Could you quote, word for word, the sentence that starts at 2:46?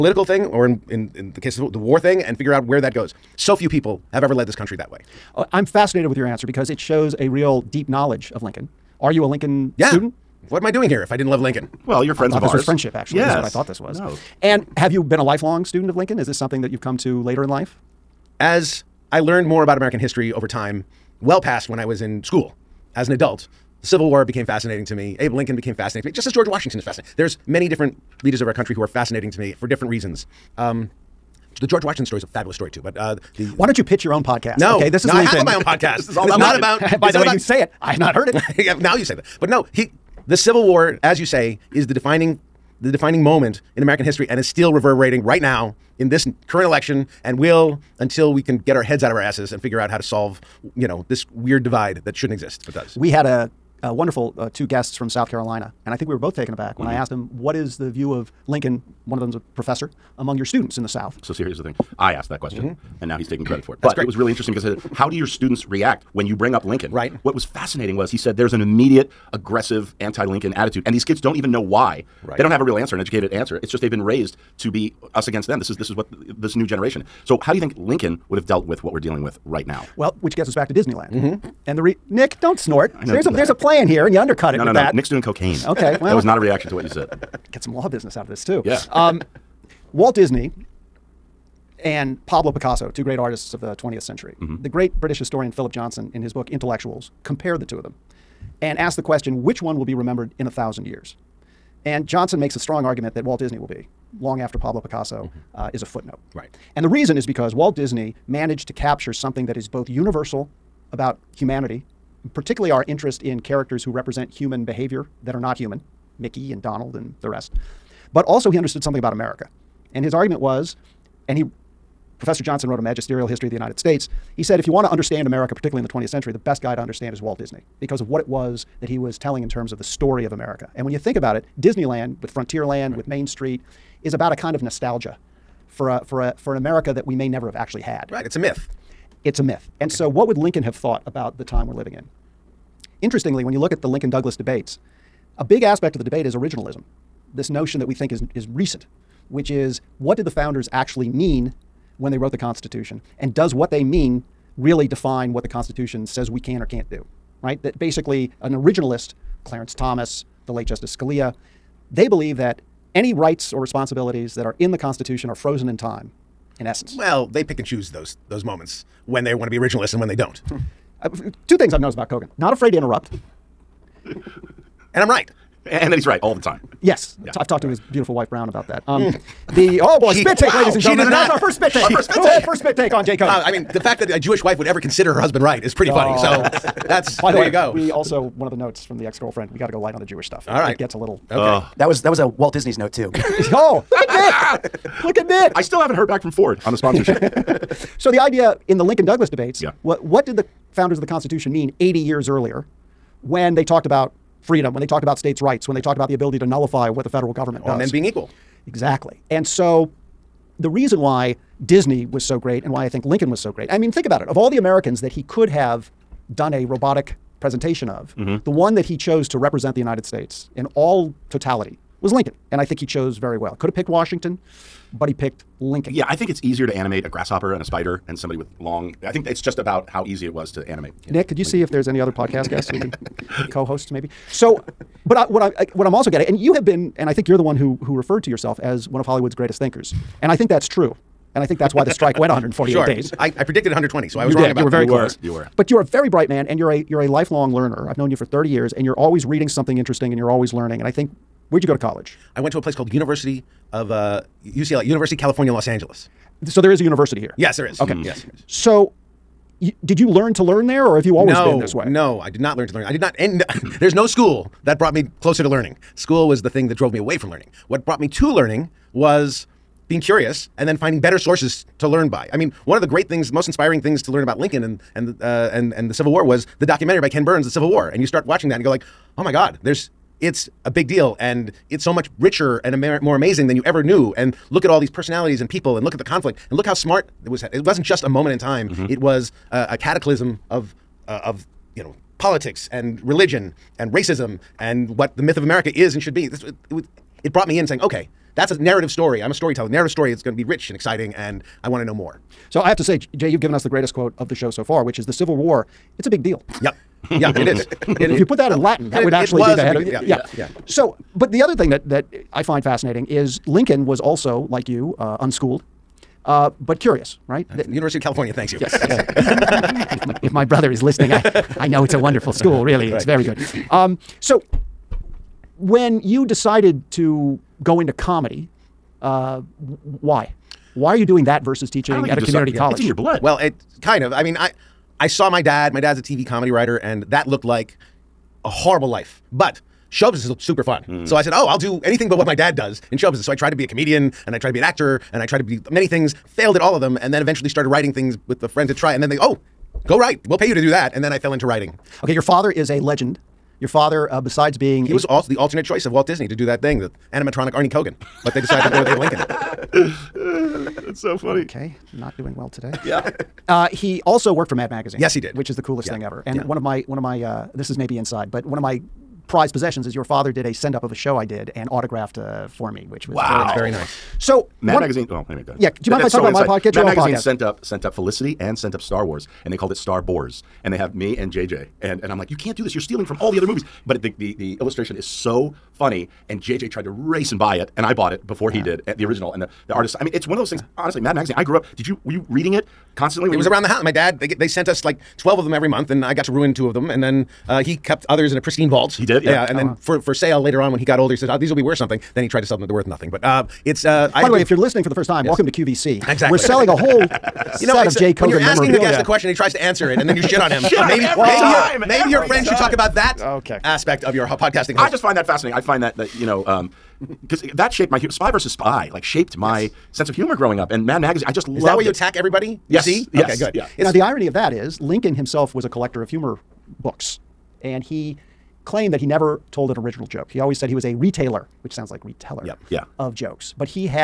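Well, they pick and choose those those moments when they want to be originalists and when they don't.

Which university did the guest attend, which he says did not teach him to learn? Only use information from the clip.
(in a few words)
UCLA.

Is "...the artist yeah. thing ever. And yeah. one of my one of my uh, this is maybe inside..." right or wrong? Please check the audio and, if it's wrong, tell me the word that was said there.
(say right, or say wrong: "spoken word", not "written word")
wrong: "coolest", not "artist".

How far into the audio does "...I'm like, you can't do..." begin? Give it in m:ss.
6:22.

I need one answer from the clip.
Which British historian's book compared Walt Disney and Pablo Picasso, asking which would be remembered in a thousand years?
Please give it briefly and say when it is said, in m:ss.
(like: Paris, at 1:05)
Philip Johnson, at 1:35.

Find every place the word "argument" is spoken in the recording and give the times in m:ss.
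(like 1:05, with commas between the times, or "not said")
1:42, 2:00.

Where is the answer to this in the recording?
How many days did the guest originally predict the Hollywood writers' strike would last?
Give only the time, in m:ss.
4:03.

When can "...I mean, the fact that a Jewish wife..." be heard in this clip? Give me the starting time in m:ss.
3:03.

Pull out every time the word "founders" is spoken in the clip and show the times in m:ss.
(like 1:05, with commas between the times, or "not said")
2:30, 3:20.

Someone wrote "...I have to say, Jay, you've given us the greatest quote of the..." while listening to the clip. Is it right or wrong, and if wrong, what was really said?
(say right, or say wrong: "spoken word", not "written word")
right.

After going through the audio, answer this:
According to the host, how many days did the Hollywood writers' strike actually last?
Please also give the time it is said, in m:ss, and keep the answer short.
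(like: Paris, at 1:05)
148, at 4:02.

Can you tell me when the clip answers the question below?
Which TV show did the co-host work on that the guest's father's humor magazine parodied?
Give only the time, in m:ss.
6:17.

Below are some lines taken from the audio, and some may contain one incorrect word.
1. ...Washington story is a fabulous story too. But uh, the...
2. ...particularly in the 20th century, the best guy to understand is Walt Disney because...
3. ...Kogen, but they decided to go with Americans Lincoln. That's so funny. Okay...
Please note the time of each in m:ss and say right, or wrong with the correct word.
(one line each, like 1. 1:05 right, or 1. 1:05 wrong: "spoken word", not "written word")
1. 0:31 right
2. 2:05 right
3. 5:57 wrong: "Abe", not "Americans".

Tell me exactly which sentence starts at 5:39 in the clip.
But show business looked super fun.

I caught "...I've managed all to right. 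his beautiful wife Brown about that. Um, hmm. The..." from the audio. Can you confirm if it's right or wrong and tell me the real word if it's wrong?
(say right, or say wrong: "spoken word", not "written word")
wrong: "talked", not "managed".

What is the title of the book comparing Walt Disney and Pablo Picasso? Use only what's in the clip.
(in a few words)
Intellectuals.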